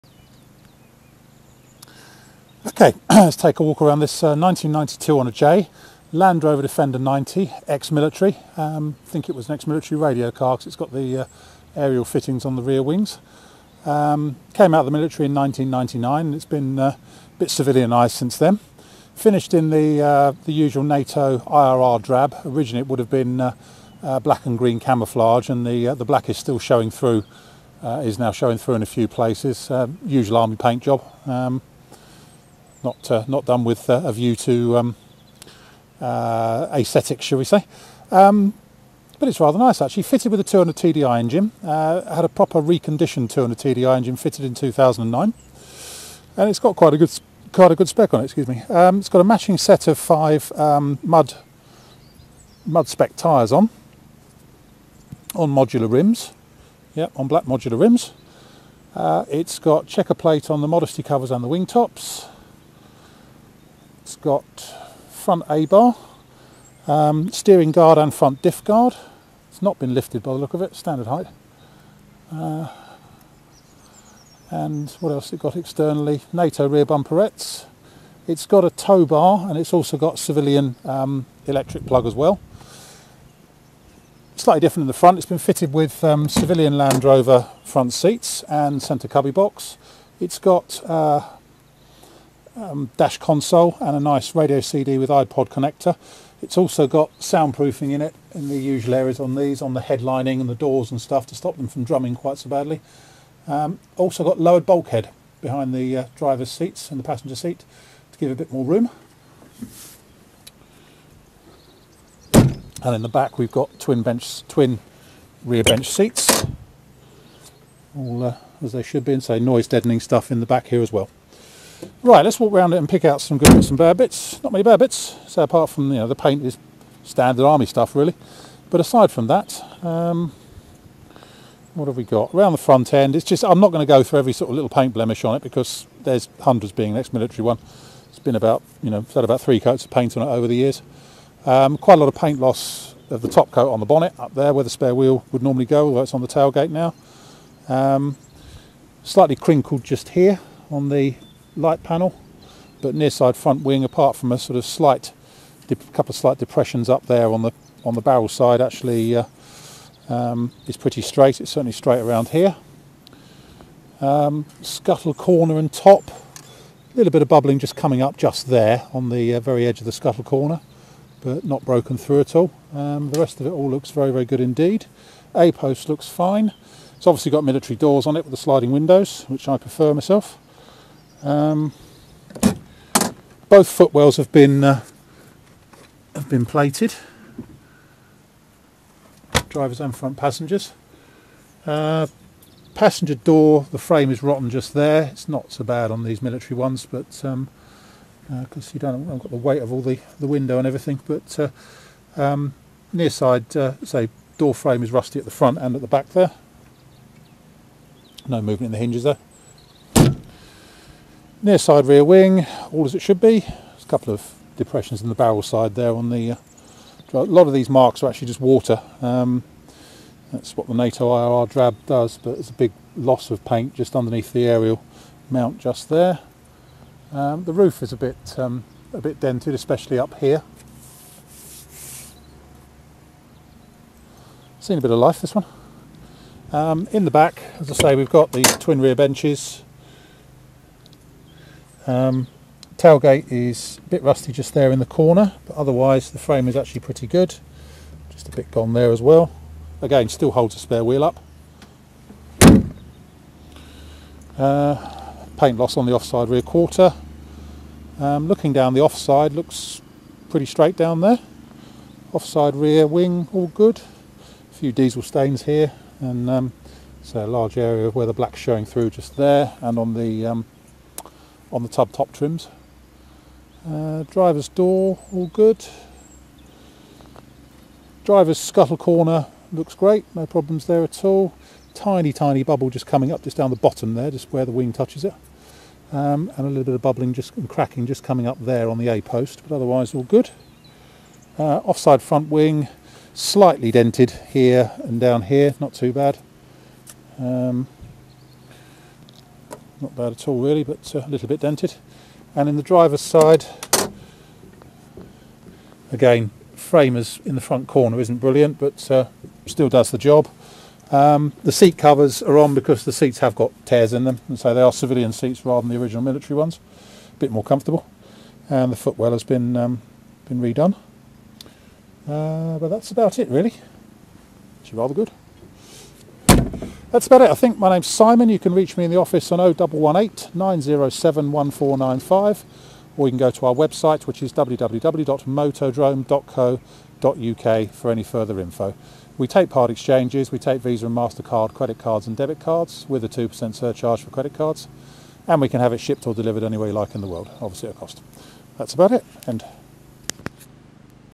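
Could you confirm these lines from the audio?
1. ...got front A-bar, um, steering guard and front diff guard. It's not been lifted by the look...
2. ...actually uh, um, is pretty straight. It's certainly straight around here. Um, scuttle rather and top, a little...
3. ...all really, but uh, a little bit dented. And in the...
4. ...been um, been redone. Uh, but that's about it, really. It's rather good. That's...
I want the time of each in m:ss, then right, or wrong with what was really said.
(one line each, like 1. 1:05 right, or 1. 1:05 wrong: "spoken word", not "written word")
1. 1:04 right
2. 2:38 wrong: "corner", not "rather"
3. 5:00 right
4. 5:19 right.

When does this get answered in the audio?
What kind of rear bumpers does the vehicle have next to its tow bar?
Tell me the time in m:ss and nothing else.
1:16.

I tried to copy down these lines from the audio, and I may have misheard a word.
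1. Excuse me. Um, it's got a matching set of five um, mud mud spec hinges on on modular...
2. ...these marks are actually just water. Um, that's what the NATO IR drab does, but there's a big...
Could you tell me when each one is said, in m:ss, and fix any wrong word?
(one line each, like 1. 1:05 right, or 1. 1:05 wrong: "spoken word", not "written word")
1. 0:48 wrong: "tyres", not "hinges"
2. 3:37 right.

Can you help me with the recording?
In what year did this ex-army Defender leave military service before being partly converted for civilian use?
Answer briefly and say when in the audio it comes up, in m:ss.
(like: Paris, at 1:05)
1999, at 0:15.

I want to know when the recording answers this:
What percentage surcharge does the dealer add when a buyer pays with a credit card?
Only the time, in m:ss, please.
5:43.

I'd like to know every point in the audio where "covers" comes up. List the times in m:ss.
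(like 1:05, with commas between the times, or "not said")
1:01, 5:11.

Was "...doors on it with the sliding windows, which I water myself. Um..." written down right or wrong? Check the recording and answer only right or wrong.
wrong.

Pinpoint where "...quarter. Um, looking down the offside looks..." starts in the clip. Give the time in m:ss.
4:16.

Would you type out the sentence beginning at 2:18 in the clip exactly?
It's been about you know it's had about three coats of paint on it over the years.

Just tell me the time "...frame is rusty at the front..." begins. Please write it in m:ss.
3:24.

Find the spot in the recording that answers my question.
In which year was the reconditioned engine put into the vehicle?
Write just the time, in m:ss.
0:44.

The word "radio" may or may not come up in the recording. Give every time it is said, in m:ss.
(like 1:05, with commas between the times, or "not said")
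0:10, 1:34.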